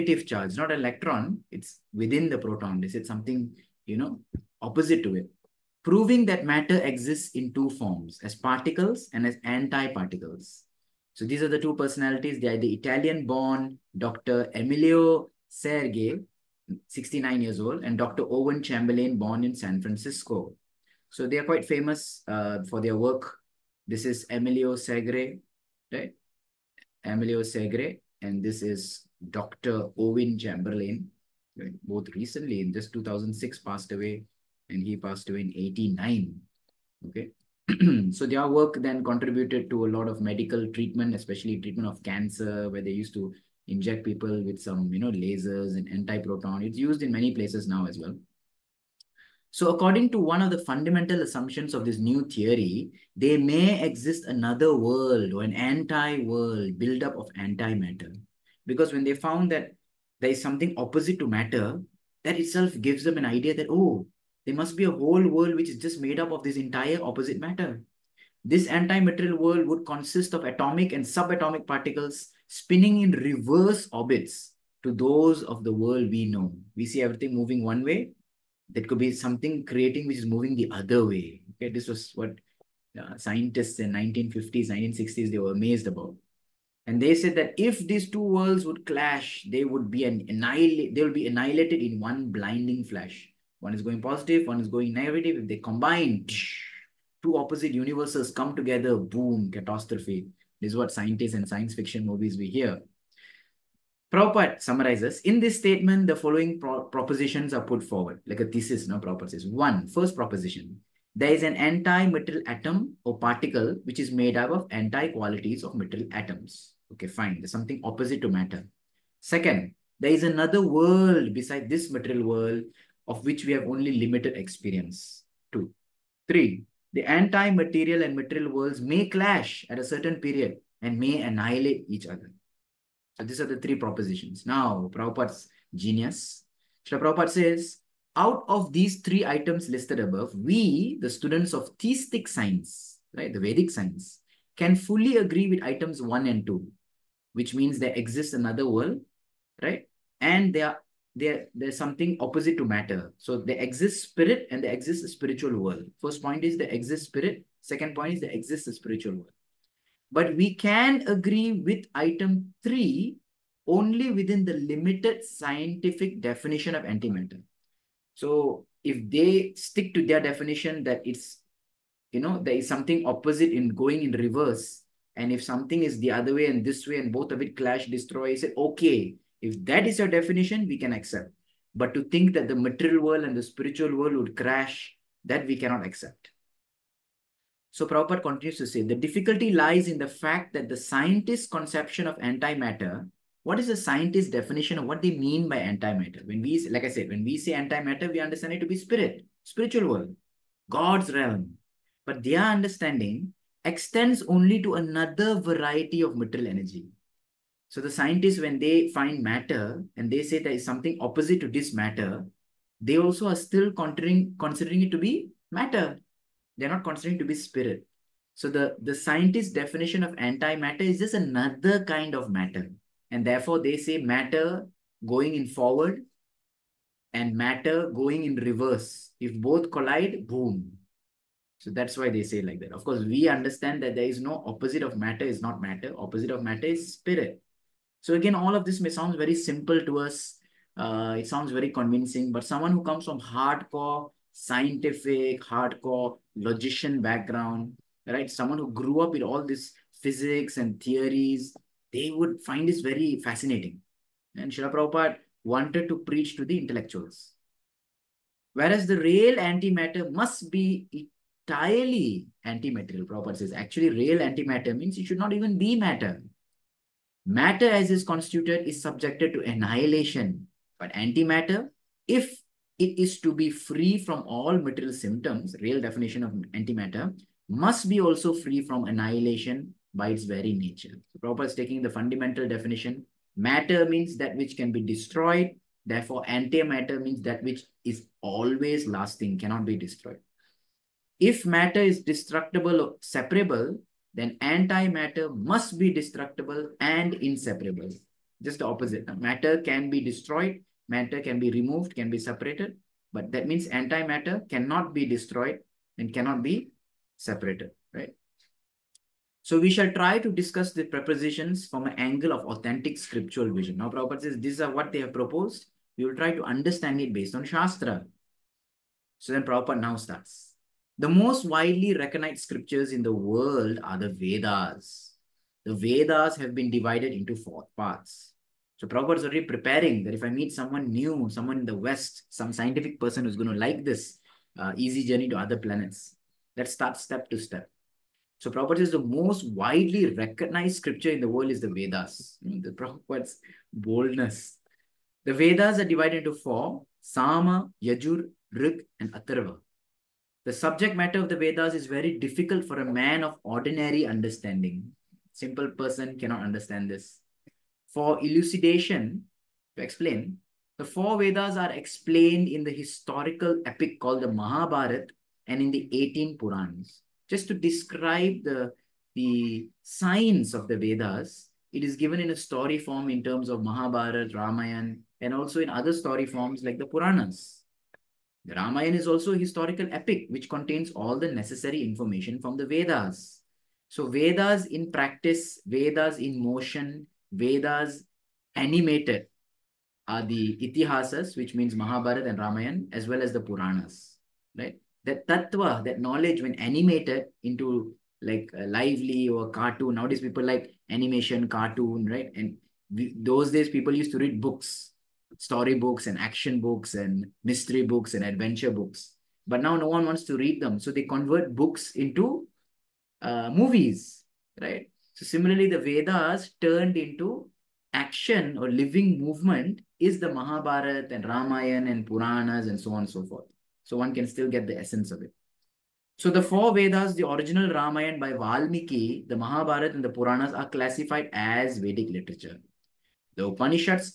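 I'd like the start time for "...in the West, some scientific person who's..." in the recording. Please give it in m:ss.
5:31.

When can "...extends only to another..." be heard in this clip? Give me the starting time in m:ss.
3:23.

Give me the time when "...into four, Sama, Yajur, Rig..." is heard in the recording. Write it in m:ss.
5:46.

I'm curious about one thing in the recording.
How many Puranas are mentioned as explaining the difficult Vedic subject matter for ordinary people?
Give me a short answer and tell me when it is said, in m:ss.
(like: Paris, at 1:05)
18, at 6:05.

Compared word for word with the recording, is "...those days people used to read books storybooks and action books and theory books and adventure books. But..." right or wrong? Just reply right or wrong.
wrong.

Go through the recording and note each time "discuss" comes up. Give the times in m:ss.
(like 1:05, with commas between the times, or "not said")
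5:10.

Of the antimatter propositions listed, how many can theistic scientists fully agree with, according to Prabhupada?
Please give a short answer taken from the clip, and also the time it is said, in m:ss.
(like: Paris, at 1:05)
2, at 2:26.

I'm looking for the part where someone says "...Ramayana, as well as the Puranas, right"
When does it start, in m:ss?
6:32.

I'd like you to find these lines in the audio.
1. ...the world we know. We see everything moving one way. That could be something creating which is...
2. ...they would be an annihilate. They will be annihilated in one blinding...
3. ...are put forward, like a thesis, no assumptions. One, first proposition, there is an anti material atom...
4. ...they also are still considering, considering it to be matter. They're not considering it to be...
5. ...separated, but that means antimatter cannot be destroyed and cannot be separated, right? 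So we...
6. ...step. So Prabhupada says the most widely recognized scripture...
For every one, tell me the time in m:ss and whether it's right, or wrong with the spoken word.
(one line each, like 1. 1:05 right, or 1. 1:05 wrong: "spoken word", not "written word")
1. 1:15 right
2. 1:29 right
3. 1:47 wrong: "propositions", not "assumptions"
4. 3:32 right
5. 5:02 right
6. 5:37 right.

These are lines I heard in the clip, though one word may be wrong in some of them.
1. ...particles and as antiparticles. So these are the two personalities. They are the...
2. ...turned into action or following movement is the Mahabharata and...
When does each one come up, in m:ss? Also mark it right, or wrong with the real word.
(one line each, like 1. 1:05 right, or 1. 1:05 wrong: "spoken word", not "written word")
1. 0:08 right
2. 6:56 wrong: "living", not "following".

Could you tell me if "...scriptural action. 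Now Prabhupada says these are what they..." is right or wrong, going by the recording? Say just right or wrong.
wrong.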